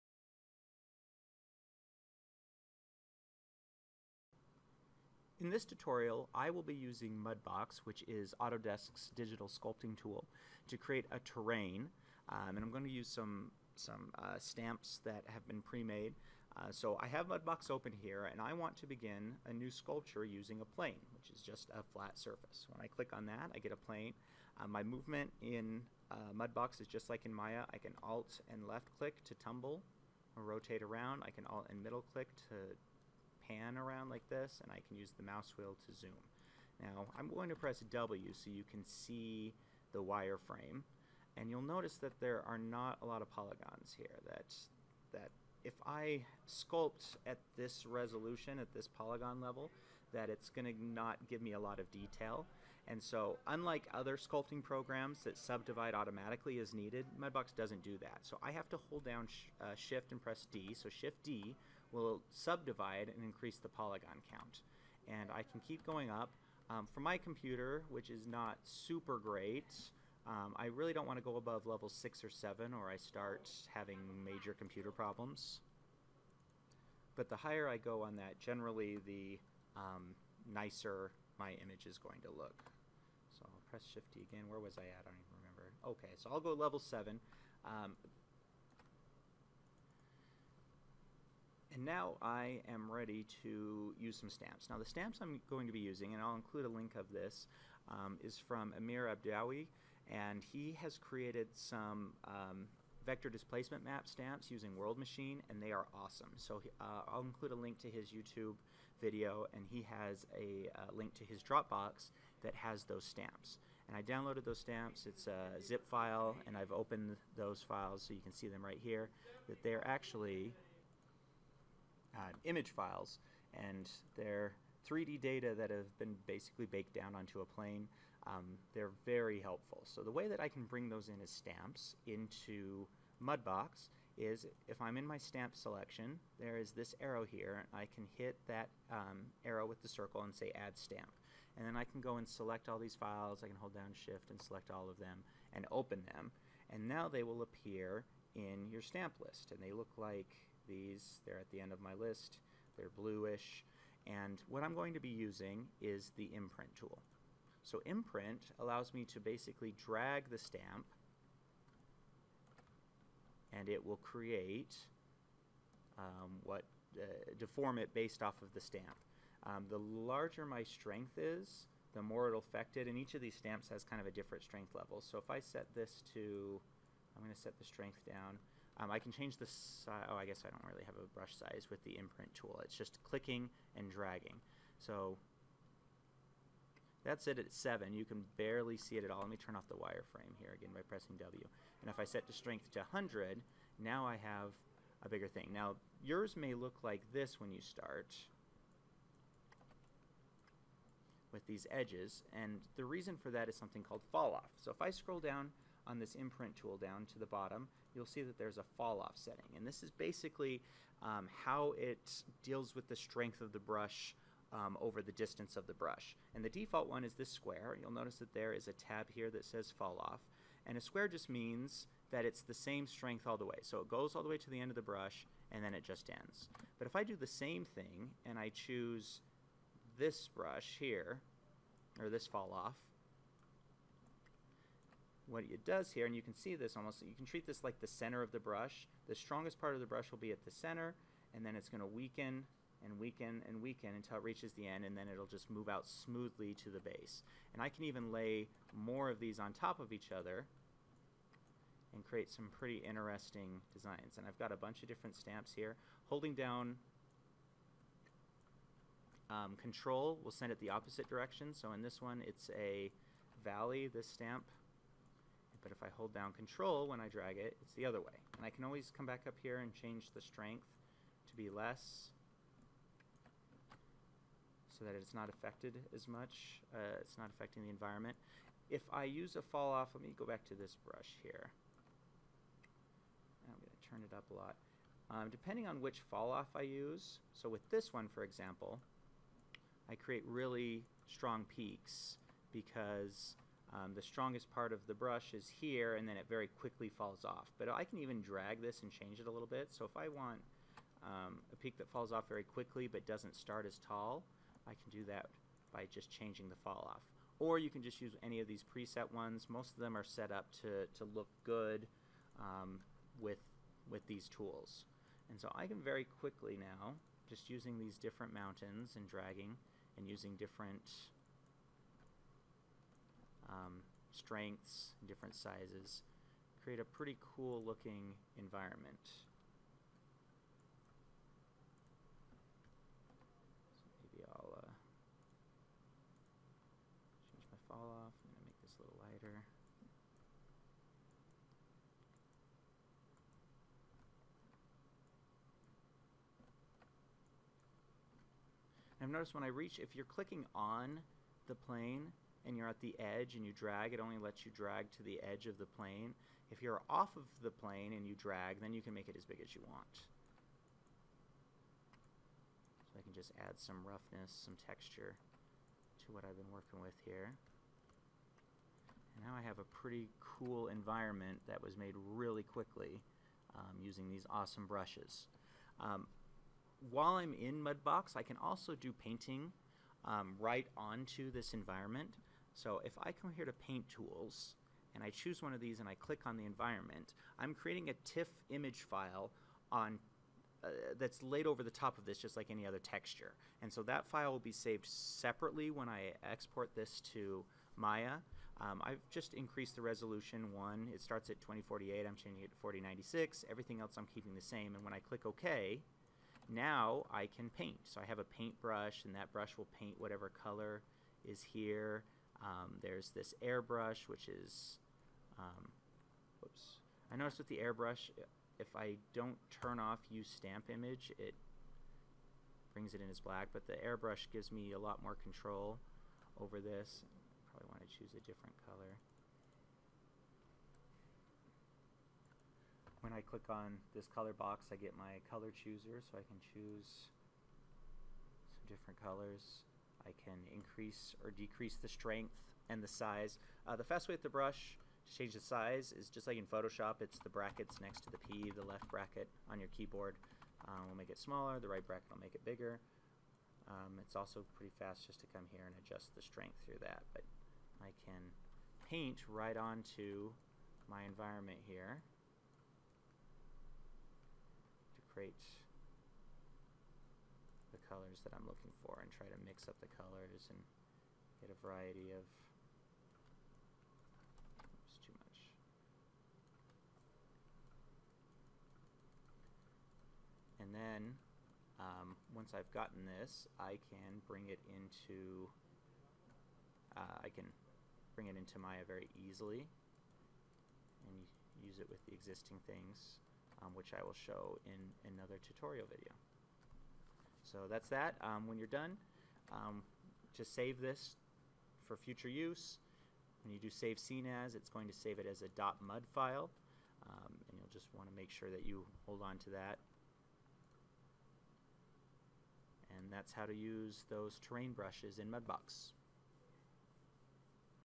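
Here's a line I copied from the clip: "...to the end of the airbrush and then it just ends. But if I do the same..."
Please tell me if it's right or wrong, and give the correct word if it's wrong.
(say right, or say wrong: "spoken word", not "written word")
wrong: "brush", not "airbrush".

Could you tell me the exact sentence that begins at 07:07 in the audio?
Probably want to choose a different color.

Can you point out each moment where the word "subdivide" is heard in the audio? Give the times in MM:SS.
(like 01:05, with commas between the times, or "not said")
00:55, 01:02.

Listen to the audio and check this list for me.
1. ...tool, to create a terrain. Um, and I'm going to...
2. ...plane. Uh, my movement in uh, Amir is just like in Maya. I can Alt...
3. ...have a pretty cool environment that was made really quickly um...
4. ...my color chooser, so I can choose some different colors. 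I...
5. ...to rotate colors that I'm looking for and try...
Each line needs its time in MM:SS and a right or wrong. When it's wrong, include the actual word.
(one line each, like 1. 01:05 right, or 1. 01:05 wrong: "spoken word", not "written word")
1. 00:09 right
2. 00:23 wrong: "Mudbox", not "Amir"
3. 06:09 right
4. 07:14 right
5. 07:44 wrong: "create", not "rotate".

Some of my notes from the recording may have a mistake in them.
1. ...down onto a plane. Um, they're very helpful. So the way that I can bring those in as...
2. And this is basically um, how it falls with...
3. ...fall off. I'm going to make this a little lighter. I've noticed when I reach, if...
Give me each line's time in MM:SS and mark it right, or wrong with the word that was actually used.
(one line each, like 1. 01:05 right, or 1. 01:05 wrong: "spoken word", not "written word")
1. 02:06 right
2. 03:29 wrong: "deals", not "falls"
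3. 05:37 right.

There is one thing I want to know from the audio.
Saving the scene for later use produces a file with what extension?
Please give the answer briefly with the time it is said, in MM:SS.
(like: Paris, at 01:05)
.mud, at 08:25.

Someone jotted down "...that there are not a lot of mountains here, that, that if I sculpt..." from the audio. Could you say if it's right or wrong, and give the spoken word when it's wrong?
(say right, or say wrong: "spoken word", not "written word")
wrong: "polygons", not "mountains".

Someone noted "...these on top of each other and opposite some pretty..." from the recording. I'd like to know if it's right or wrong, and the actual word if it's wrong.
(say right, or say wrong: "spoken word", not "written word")
wrong: "create", not "opposite".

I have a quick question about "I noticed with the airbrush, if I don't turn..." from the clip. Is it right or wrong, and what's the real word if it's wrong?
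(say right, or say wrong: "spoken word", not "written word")
right.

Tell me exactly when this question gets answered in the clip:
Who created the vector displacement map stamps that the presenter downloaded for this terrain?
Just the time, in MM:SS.
01:38.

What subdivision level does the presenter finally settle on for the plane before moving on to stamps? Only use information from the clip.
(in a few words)
7.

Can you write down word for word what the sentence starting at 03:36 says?
And the default one is this square.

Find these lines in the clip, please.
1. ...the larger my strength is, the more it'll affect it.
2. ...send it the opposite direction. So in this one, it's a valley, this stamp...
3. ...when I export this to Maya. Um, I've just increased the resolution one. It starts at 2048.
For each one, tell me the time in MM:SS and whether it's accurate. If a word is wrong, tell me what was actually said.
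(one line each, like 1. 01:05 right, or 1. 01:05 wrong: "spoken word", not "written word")
1. 02:49 right
2. 04:20 right
3. 06:35 right.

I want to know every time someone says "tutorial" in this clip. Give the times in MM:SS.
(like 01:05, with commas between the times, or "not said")
00:05, 08:15.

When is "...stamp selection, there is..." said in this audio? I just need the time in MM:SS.
02:15.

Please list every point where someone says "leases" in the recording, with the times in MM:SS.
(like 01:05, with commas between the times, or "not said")
not said.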